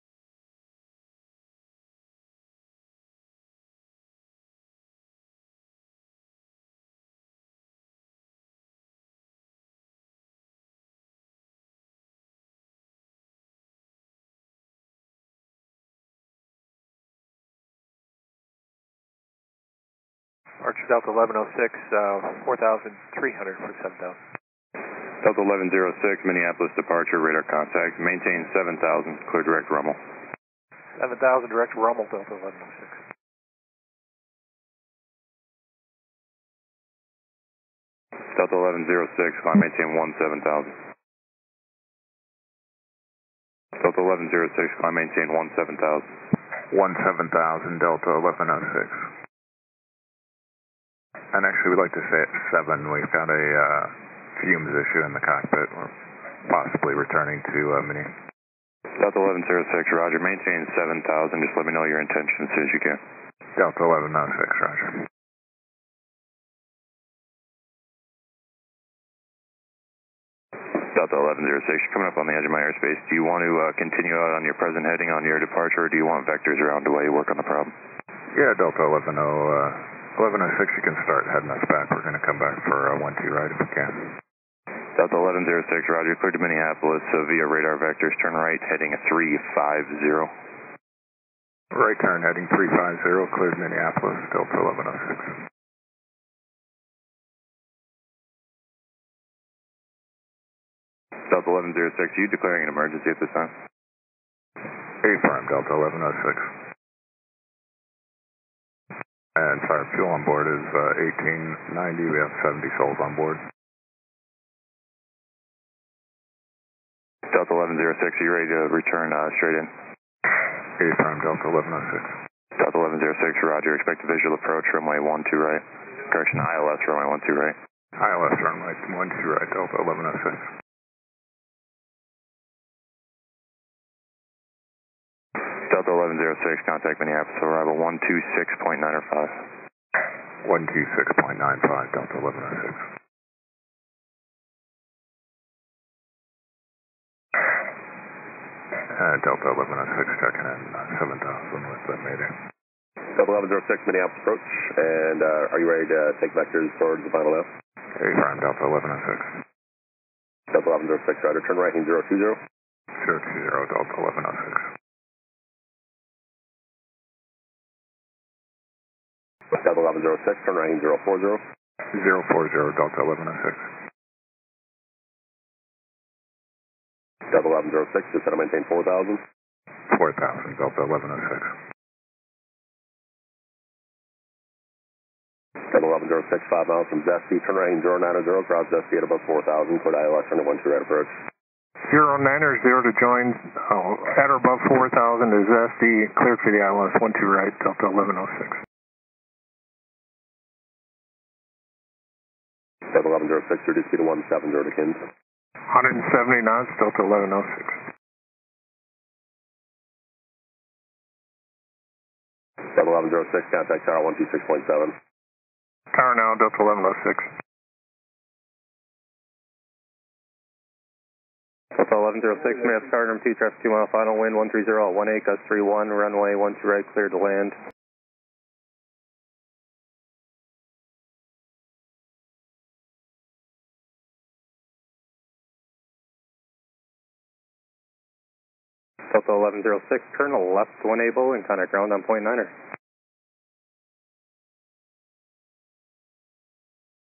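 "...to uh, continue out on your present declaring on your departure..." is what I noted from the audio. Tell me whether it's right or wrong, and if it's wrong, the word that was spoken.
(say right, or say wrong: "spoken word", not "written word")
wrong: "heading", not "declaring".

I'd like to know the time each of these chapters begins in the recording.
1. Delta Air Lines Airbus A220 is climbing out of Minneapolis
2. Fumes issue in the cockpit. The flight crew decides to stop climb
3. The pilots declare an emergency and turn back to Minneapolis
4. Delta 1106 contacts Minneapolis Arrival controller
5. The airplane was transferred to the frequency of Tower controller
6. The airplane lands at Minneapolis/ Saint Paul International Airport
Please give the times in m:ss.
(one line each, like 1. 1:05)
1. 0:17
2. 0:37
3. 1:10
4. 2:25
5. 3:32
6. 3:53.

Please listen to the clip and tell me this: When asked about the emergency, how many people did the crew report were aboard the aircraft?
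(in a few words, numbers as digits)
70.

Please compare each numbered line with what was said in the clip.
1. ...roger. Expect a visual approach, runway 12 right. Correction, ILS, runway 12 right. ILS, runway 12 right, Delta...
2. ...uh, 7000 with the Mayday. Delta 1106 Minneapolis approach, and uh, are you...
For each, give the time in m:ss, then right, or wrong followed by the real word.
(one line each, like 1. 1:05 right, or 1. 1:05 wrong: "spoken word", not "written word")
1. 2:03 right
2. 2:30 right.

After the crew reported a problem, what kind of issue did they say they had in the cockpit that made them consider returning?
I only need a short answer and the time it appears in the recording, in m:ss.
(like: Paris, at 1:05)
Fumes, at 0:54.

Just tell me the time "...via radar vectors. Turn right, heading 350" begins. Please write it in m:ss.
1:27.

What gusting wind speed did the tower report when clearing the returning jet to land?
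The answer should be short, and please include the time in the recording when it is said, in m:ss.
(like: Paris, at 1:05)
31, at 3:45.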